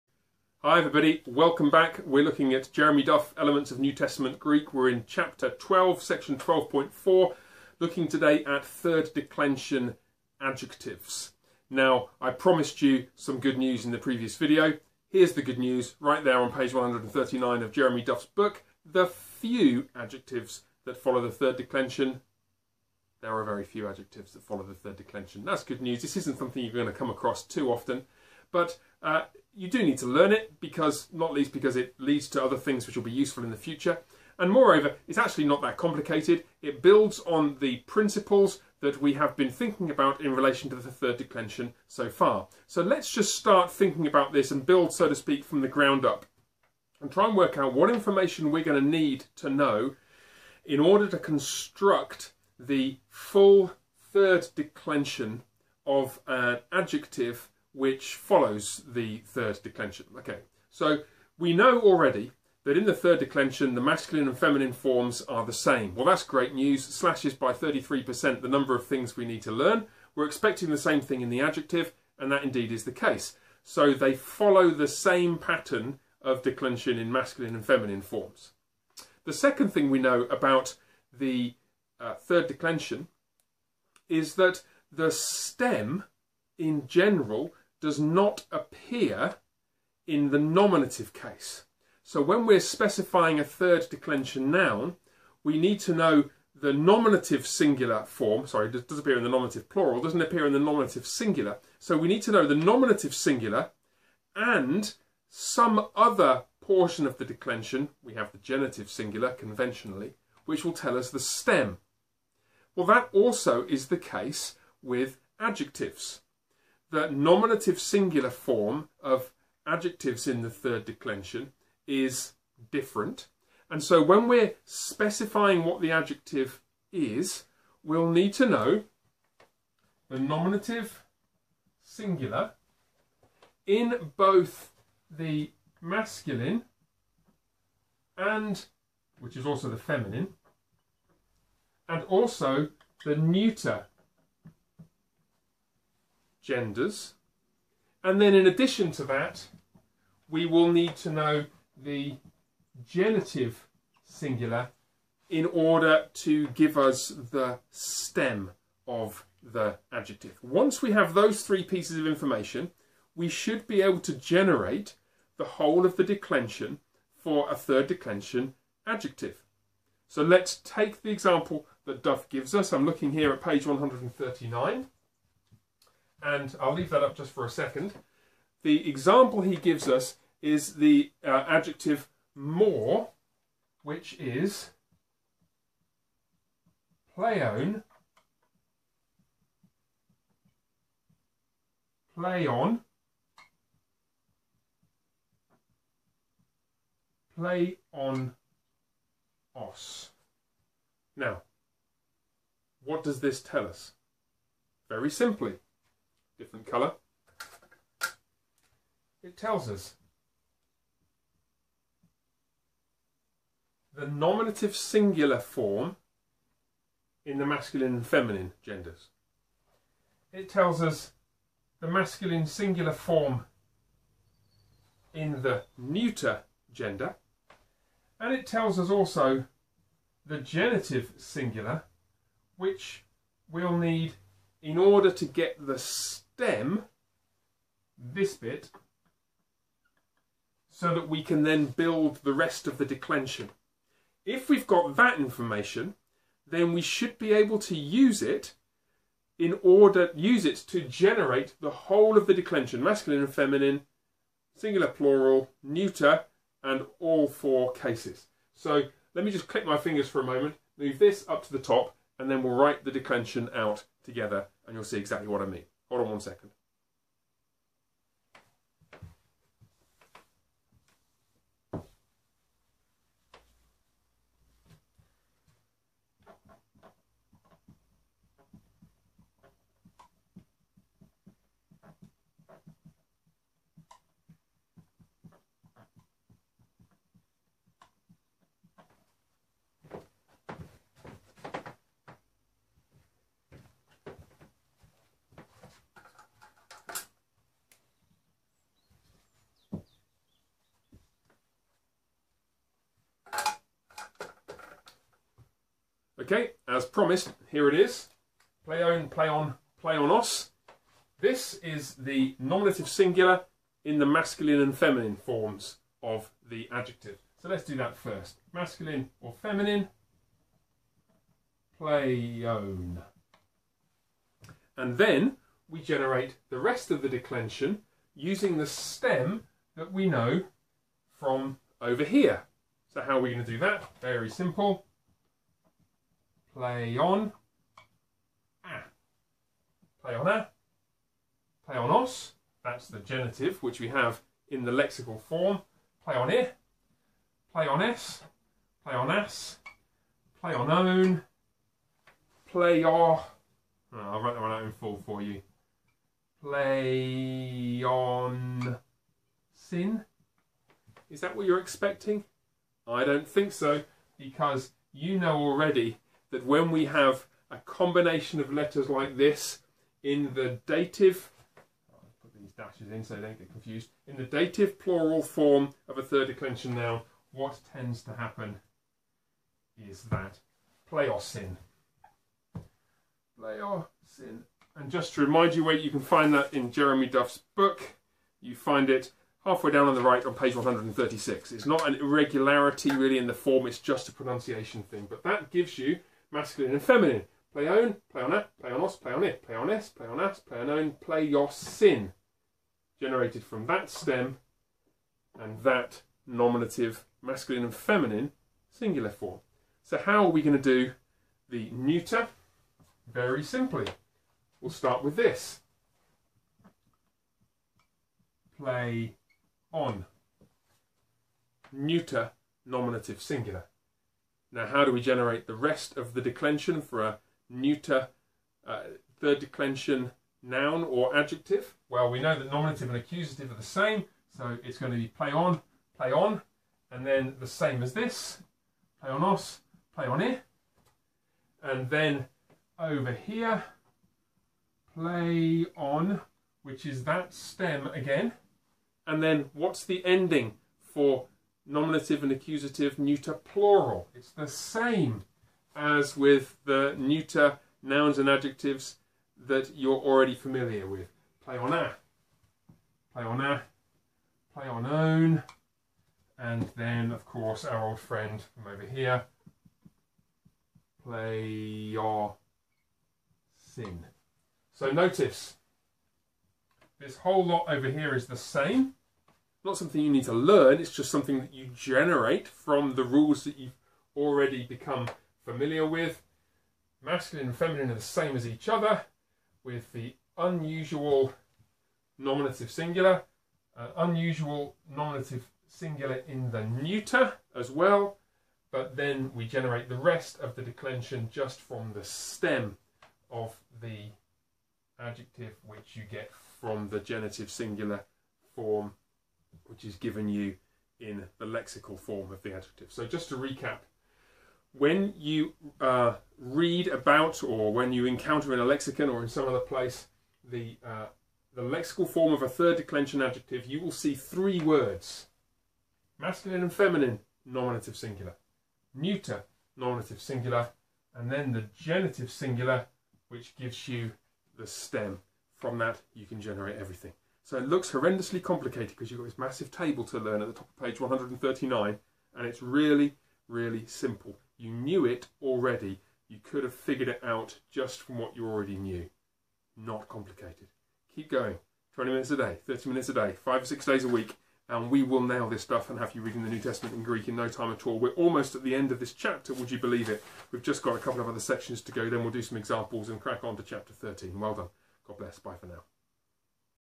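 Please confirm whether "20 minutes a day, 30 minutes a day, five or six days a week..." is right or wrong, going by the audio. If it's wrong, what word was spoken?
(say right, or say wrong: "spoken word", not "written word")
right.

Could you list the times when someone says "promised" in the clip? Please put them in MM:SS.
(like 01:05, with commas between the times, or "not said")
00:12, 05:06.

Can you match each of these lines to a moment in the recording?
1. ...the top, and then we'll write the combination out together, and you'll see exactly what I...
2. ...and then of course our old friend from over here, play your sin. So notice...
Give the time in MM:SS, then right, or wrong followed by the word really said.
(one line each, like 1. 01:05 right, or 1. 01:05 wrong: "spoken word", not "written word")
1. 04:21 wrong: "declension", not "combination"
2. 07:46 right.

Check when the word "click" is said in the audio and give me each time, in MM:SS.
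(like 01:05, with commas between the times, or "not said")
04:19.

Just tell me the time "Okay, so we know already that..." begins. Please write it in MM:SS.
01:00.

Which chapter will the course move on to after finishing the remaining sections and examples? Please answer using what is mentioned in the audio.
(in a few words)
Chapter 13.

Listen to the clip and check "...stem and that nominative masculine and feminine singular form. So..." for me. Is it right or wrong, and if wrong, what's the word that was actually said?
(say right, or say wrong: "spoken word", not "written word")
right.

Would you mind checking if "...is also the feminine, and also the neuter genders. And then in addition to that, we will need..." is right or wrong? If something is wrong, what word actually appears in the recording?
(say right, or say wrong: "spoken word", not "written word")
right.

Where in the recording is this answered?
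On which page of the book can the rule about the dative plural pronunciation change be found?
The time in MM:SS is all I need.
06:30.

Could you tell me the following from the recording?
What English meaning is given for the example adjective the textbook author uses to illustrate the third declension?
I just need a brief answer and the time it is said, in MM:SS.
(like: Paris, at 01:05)
more, at 03:02.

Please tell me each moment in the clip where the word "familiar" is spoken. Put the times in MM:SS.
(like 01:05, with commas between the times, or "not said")
07:40, 08:05.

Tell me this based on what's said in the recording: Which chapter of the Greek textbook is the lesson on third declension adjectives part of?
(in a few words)
Chapter 12.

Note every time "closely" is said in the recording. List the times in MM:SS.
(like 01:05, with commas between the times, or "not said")
not said.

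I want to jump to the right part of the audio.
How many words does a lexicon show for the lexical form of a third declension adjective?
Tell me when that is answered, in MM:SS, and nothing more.
08:44.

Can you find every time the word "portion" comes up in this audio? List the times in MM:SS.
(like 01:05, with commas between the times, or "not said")
01:46.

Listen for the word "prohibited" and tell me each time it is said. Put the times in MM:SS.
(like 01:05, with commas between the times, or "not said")
not said.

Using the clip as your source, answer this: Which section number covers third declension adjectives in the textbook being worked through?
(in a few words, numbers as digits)
12.4.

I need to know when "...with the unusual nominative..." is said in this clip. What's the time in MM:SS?
08:09.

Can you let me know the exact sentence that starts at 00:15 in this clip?
Here's the good news right there on page 139 of Jeremy Duff's book.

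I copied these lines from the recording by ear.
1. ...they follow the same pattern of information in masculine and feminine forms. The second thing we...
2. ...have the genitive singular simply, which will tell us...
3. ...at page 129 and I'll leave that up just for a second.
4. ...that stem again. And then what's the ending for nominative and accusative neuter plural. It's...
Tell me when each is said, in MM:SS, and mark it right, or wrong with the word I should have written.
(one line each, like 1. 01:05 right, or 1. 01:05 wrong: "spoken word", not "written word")
1. 01:13 wrong: "declension", not "information"
2. 01:48 wrong: "conventionally", not "simply"
3. 02:53 wrong: "139", not "129"
4. 07:27 right.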